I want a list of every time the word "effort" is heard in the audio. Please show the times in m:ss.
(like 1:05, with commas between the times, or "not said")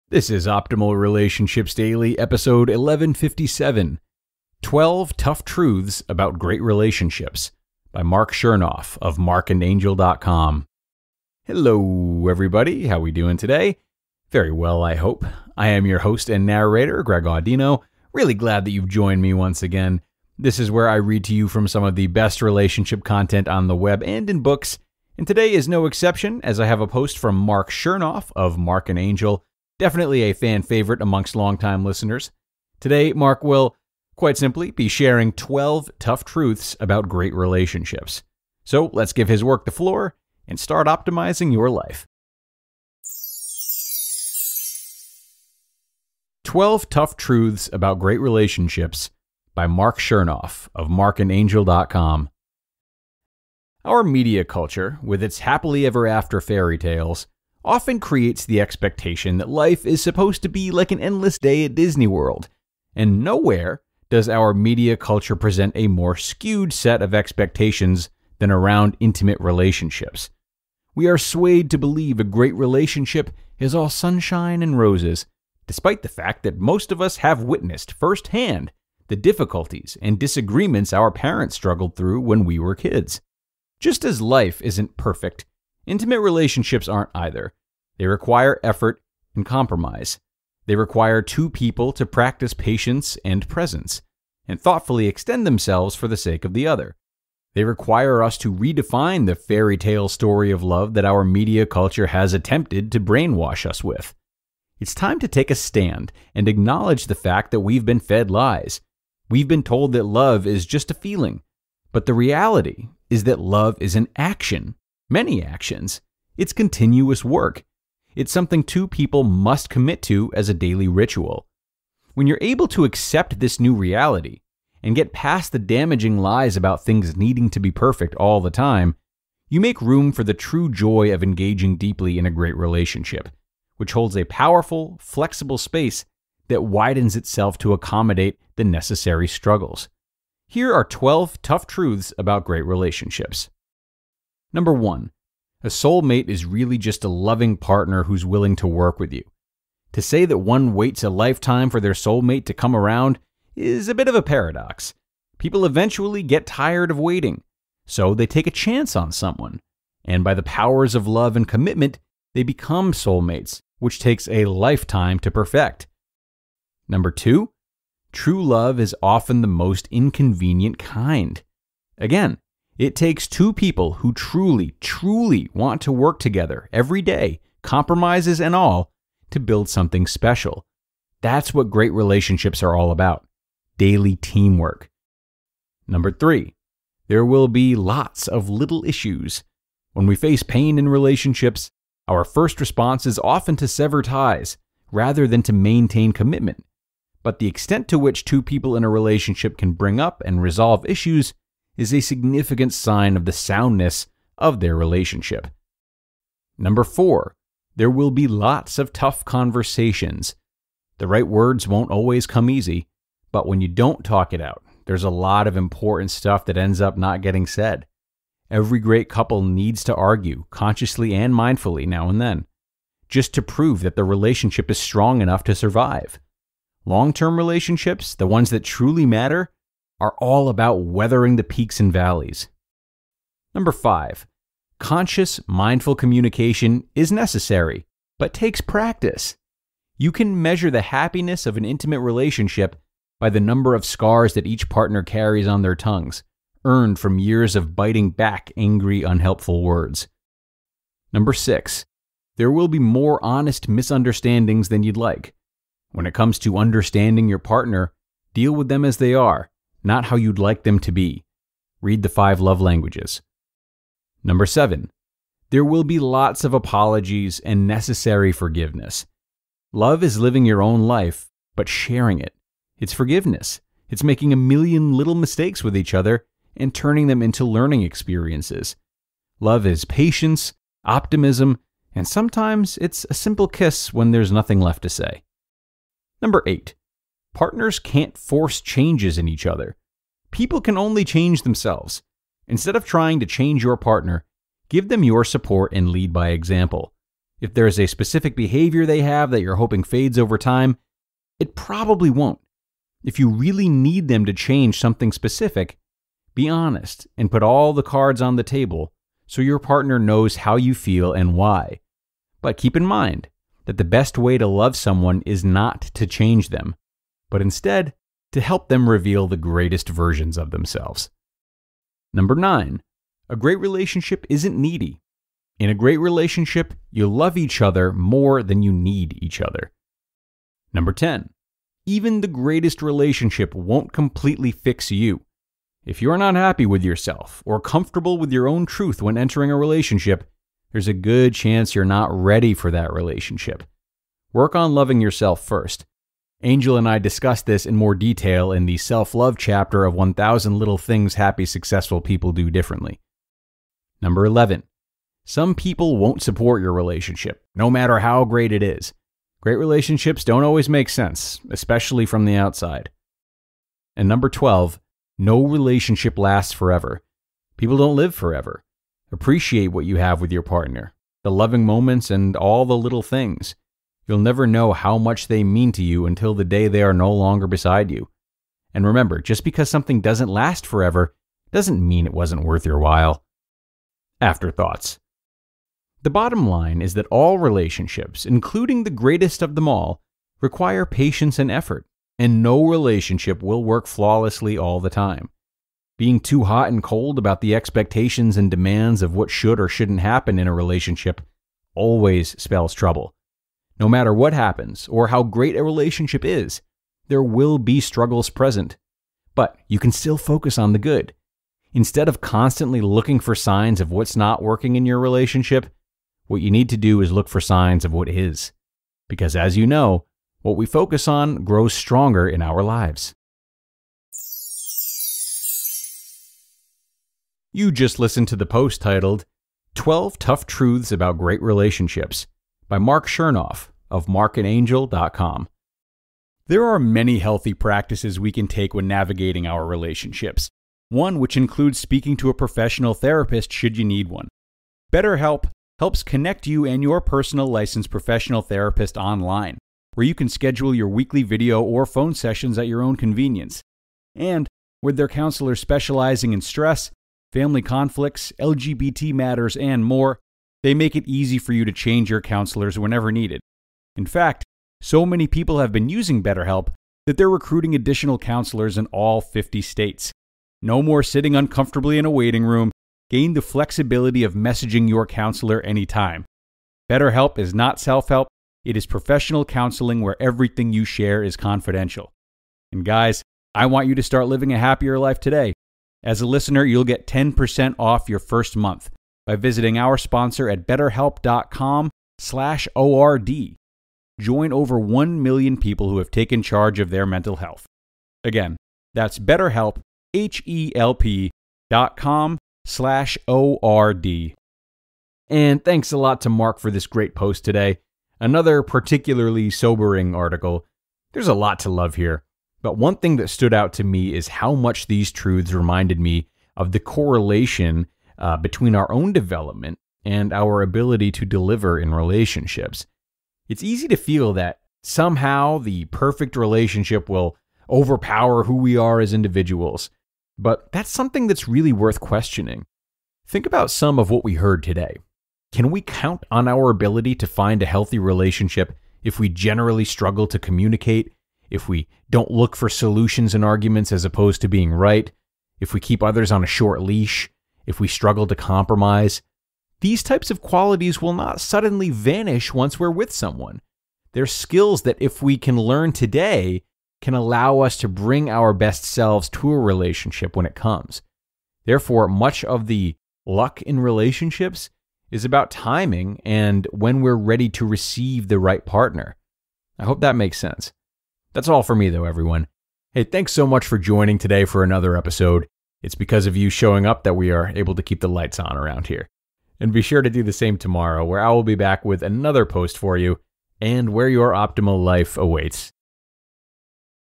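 1:28, 6:31.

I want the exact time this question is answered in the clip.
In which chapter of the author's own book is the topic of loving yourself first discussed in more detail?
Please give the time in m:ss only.
5:48.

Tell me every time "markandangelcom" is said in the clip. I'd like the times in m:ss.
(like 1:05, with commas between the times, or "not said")
0:09, 0:50, 7:14.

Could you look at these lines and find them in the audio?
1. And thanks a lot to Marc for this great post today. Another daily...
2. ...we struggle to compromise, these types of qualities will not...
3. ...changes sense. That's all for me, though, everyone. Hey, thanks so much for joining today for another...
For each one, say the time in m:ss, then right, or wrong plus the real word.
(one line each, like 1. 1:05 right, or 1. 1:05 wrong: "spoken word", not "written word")
1. 8:25 wrong: "particularly", not "daily"
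2. 9:07 right
3. 9:30 wrong: "makes", not "changes".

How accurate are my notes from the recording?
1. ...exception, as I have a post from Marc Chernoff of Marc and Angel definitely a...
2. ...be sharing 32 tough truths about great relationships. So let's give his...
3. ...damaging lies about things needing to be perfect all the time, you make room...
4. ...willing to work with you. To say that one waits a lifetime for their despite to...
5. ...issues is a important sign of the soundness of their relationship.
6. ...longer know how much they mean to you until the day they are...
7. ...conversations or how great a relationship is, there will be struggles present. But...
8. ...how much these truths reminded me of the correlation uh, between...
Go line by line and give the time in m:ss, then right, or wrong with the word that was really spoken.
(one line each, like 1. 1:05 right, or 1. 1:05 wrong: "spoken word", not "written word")
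1. 0:25 right
2. 0:34 wrong: "12", not "32"
3. 2:05 right
4. 2:28 wrong: "soulmate", not "despite"
5. 3:20 wrong: "significant", not "important"
6. 6:14 wrong: "never", not "longer"
7. 6:44 wrong: "happens", not "conversations"
8. 8:34 right.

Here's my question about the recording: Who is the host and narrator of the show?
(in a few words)
Greg Audino.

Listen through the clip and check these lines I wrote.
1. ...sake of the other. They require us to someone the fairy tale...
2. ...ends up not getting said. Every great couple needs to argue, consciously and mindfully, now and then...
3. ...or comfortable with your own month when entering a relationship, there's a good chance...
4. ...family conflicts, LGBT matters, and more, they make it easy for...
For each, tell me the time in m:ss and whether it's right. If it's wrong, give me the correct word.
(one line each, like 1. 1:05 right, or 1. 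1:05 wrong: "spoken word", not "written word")
1. 1:36 wrong: "redefine", not "someone"
2. 3:36 right
3. 5:37 wrong: "truth", not "month"
4. 7:37 right.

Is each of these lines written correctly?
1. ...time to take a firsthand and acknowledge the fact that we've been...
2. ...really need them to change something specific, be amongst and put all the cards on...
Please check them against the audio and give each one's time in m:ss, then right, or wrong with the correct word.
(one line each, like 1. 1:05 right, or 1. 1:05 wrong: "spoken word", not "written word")
1. 1:44 wrong: "stand", not "firsthand"
2. 5:03 wrong: "honest", not "amongst".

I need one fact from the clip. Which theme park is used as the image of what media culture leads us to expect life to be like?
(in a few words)
Disney World.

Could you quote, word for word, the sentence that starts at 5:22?
Number nine, a great relationship isn't needy.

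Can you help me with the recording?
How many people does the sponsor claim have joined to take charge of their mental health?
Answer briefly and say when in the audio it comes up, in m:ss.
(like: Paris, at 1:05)
Over 1 million, at 8:14.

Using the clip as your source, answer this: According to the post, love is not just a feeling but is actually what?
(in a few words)
An action.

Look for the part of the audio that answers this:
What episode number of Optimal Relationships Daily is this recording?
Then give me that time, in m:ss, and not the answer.
0:02.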